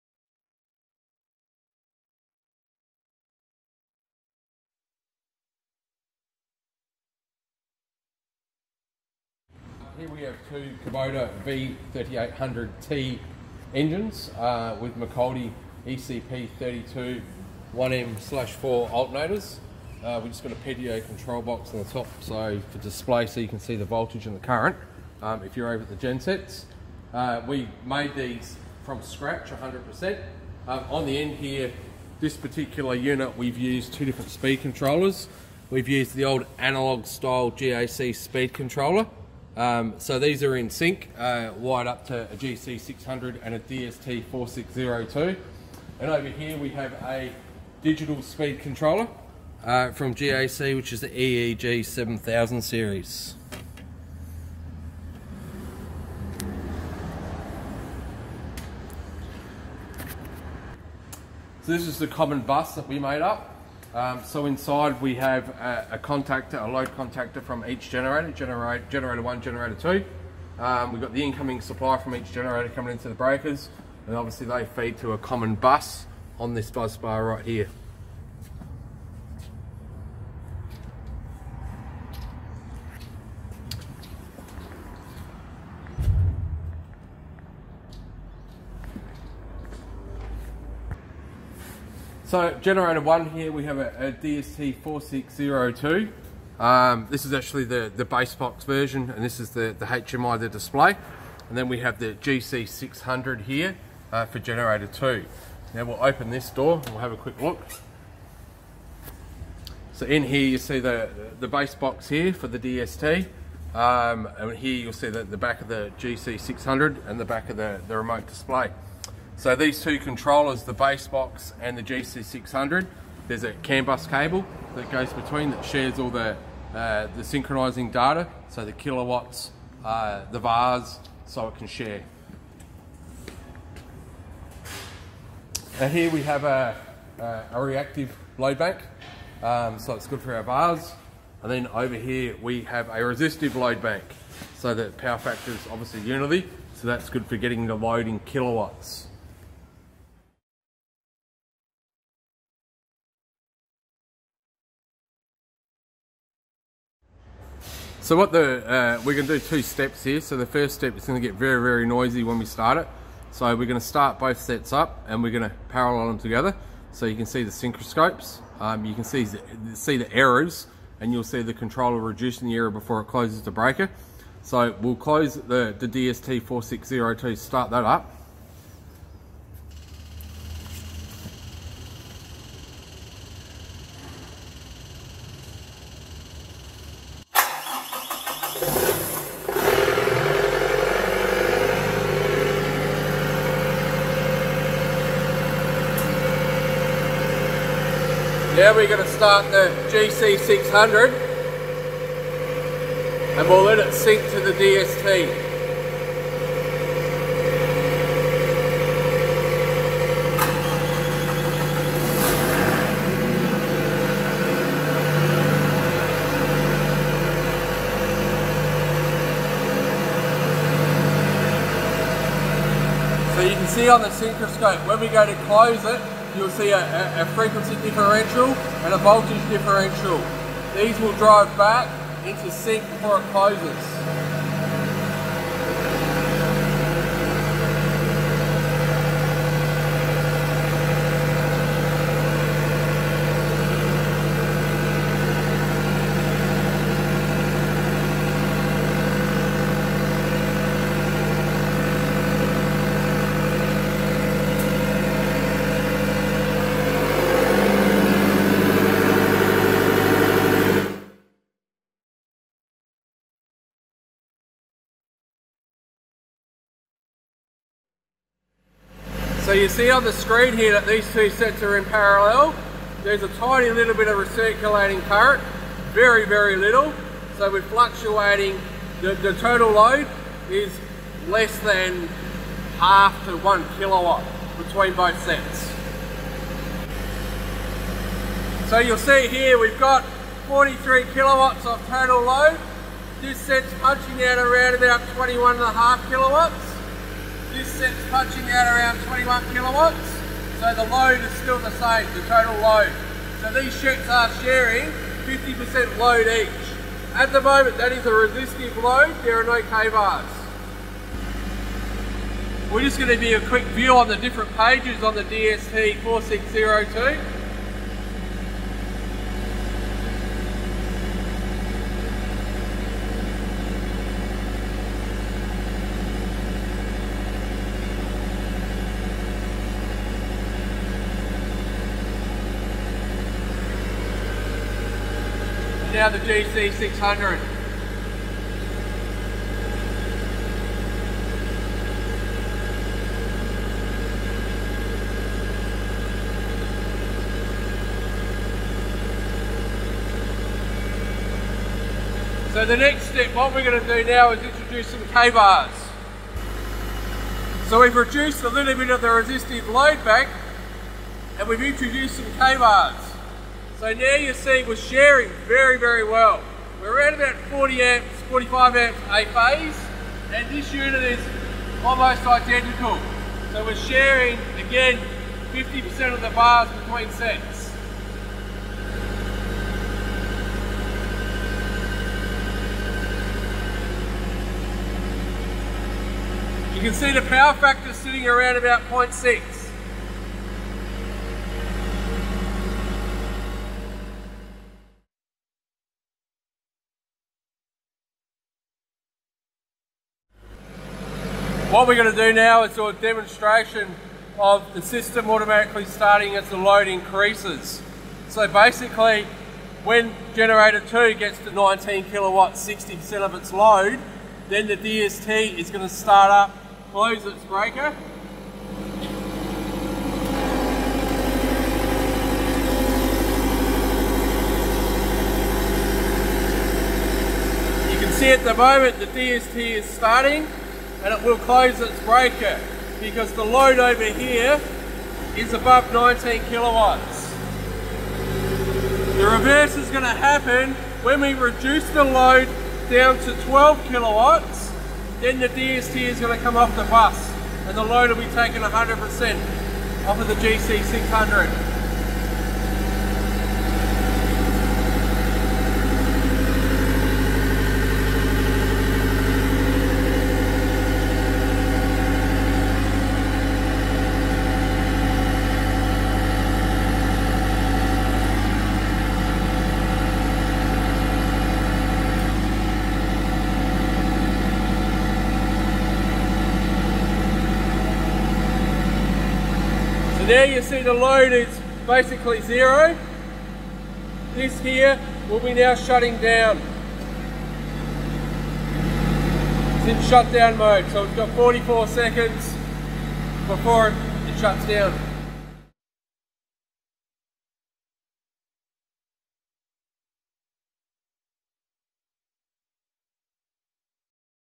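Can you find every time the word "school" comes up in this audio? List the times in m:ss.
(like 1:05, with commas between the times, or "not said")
not said.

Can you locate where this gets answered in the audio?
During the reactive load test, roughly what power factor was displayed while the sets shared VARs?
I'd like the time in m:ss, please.
6:28.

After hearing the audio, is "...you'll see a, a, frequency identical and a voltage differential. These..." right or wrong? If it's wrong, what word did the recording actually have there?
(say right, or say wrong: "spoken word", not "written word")
wrong: "differential", not "identical".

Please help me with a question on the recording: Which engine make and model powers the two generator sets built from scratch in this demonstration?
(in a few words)
Kubota V3800T.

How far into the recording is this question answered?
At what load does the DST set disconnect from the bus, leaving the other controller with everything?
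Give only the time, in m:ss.
7:23.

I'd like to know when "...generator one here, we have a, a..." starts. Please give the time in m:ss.
1:32.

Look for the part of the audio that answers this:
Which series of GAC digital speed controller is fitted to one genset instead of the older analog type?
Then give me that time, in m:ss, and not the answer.
0:51.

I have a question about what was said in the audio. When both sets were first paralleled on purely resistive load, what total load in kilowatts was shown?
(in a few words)
43 kilowatts.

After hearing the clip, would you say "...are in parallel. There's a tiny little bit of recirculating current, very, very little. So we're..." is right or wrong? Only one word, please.
right.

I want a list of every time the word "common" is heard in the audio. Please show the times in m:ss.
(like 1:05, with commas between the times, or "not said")
1:02, 1:15.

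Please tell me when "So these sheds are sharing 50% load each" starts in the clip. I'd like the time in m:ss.
5:03.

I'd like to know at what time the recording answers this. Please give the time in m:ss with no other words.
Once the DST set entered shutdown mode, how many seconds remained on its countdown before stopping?
8:11.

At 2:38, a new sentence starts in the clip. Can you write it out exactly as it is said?
So what the, uh, we're gonna do two steps here.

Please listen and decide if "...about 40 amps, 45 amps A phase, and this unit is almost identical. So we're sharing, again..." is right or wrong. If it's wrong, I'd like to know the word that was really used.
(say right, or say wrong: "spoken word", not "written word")
right.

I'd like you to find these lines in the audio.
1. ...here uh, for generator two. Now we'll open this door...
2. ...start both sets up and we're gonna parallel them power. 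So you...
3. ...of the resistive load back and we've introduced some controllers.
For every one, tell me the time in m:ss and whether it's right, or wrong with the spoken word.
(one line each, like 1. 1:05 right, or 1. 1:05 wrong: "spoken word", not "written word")
1. 1:43 right
2. 2:43 wrong: "together", not "power"
3. 5:58 wrong: "kVARs", not "controllers".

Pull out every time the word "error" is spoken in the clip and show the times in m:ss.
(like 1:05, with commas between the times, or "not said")
2:52.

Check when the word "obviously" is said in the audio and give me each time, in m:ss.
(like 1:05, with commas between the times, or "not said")
1:14, 2:25.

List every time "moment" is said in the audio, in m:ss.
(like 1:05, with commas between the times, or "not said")
5:07, 7:08.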